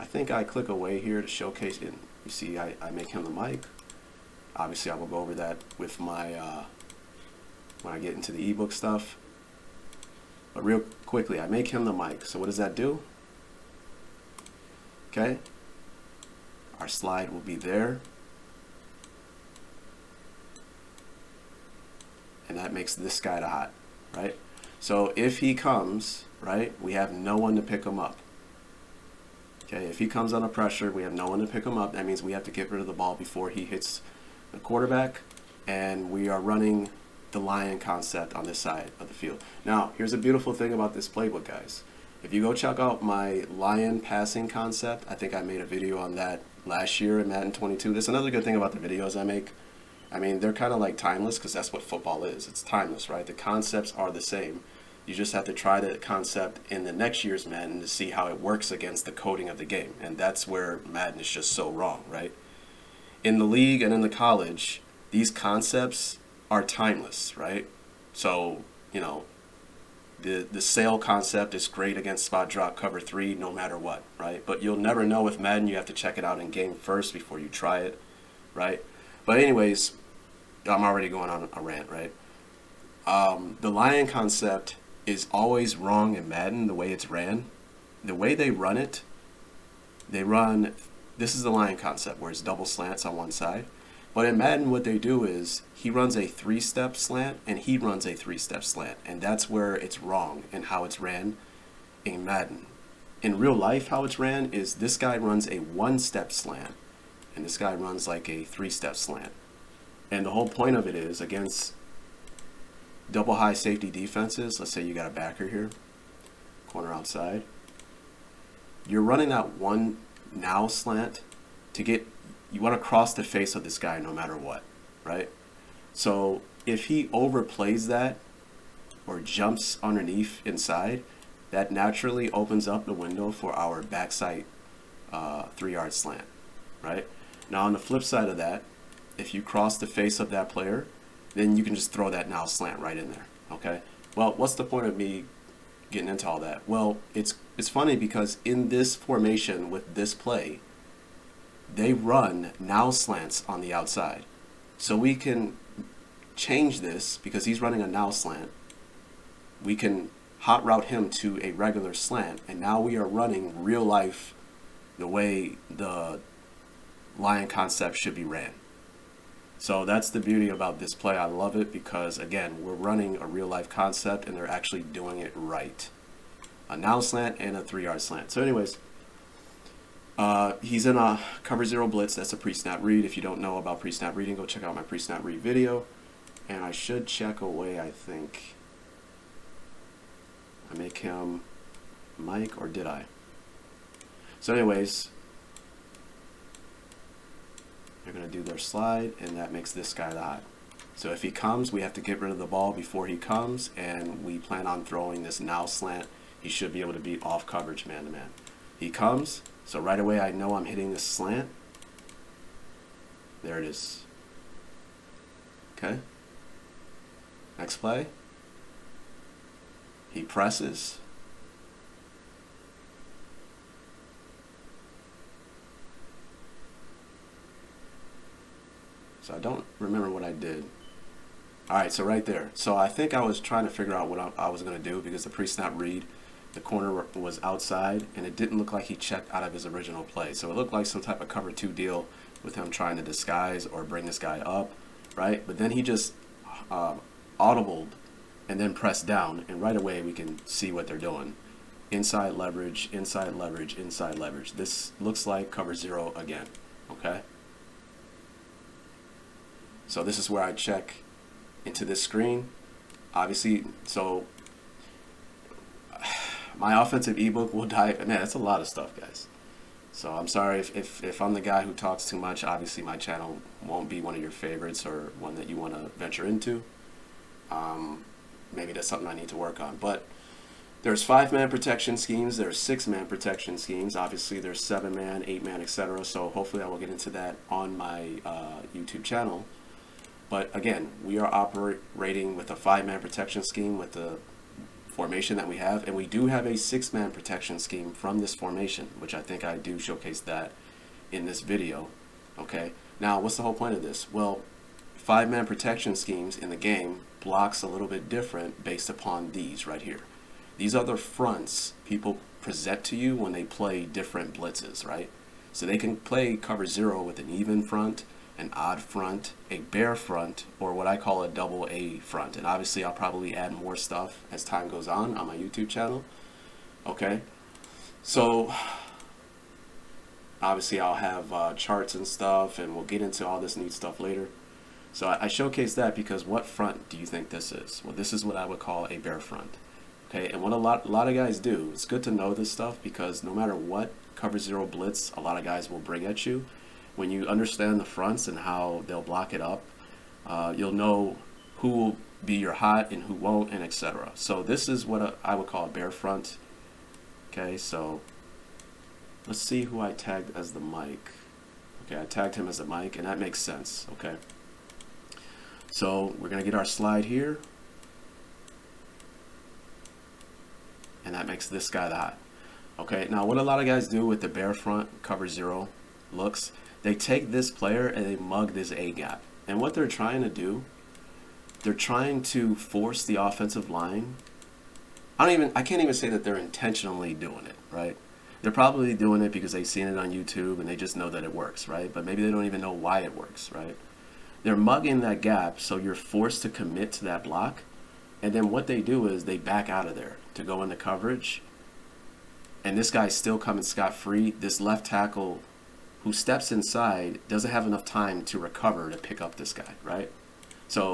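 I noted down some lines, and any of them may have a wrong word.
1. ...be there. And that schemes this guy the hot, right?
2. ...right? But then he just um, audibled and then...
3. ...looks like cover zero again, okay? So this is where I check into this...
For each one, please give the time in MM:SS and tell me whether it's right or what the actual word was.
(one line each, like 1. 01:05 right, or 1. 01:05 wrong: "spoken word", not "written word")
1. 00:17 wrong: "makes", not "schemes"
2. 04:05 right
3. 04:14 right.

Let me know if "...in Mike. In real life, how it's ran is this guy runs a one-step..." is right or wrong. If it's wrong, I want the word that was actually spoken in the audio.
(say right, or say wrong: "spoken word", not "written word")
wrong: "Madden", not "Mike".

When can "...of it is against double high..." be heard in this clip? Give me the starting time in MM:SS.
01:50.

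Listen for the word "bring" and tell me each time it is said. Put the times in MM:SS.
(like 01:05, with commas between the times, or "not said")
04:03, 05:45.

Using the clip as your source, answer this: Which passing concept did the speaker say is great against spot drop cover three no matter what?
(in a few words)
sail concept.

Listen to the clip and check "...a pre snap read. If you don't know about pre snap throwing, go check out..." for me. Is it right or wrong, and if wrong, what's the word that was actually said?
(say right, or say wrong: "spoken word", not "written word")
wrong: "reading", not "throwing".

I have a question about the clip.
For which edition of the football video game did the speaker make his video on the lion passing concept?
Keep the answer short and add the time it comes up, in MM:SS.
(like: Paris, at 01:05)
Madden 22, at 00:47.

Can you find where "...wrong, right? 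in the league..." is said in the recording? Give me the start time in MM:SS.
01:01.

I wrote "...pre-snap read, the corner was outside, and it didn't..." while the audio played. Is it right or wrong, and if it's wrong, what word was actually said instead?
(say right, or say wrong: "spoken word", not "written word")
right.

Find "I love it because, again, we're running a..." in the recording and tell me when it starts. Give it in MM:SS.
02:51.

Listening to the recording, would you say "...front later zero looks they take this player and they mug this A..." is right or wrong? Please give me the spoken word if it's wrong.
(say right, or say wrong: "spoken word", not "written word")
wrong: "cover", not "later".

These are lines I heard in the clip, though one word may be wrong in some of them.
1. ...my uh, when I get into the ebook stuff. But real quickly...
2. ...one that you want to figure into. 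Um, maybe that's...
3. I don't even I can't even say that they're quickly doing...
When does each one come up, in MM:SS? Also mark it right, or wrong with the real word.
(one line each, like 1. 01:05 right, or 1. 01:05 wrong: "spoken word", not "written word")
1. 00:05 right
2. 04:35 wrong: "venture", not "figure"
3. 06:25 wrong: "intentionally", not "quickly".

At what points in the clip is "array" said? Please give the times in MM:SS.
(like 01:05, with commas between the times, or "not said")
not said.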